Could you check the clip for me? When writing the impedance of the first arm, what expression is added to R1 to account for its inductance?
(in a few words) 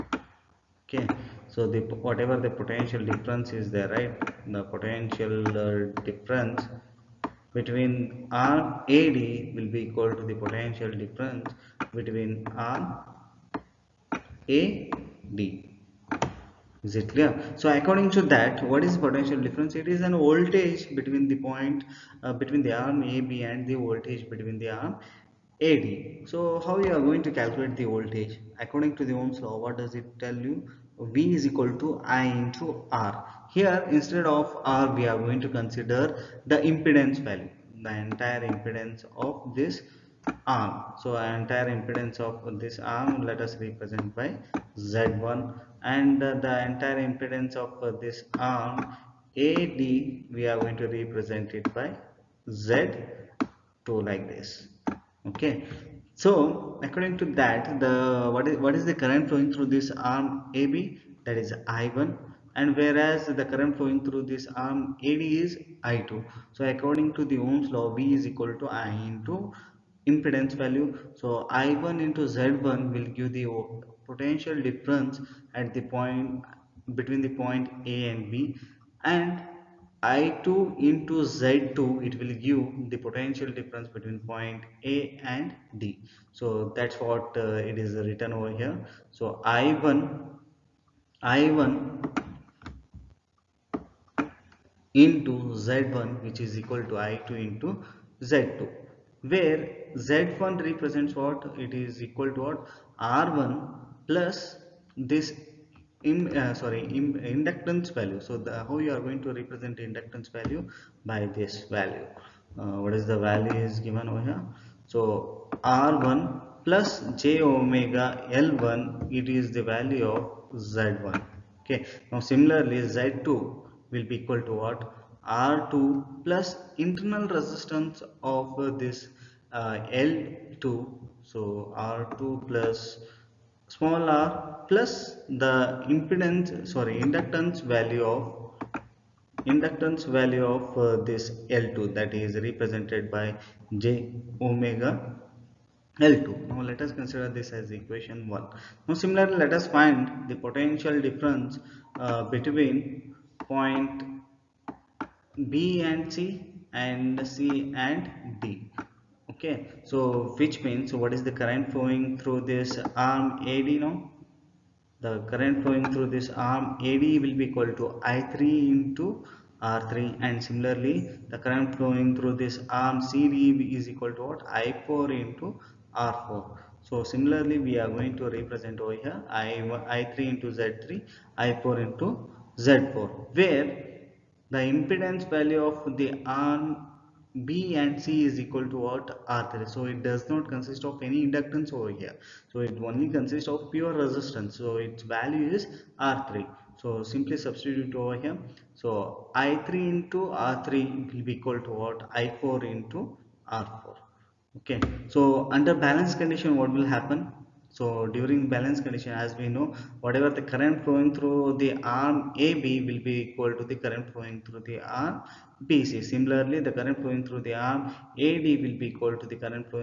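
j omega L1.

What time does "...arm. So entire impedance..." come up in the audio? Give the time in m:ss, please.
0:40.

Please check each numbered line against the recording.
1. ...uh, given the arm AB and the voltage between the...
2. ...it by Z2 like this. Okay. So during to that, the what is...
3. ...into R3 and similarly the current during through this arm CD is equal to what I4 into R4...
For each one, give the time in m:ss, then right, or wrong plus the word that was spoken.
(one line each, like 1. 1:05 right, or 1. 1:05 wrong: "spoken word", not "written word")
1. 0:22 wrong: "between", not "given"
2. 0:51 wrong: "according", not "during"
3. 2:48 wrong: "flowing", not "during".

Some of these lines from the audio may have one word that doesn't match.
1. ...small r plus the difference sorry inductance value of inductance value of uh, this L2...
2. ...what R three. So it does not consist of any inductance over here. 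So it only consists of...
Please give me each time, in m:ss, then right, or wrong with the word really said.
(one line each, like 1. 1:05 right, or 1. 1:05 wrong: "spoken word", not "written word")
1. 2:13 wrong: "impedance", not "difference"
2. 3:08 right.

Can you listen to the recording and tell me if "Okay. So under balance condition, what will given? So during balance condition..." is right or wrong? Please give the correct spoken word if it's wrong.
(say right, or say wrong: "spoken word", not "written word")
wrong: "happen", not "given".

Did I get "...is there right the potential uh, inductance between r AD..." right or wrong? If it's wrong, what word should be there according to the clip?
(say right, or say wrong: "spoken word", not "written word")
wrong: "difference", not "inductance".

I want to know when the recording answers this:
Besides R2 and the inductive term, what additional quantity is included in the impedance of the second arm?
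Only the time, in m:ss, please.
2:06.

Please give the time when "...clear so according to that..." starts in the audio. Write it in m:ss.
0:17.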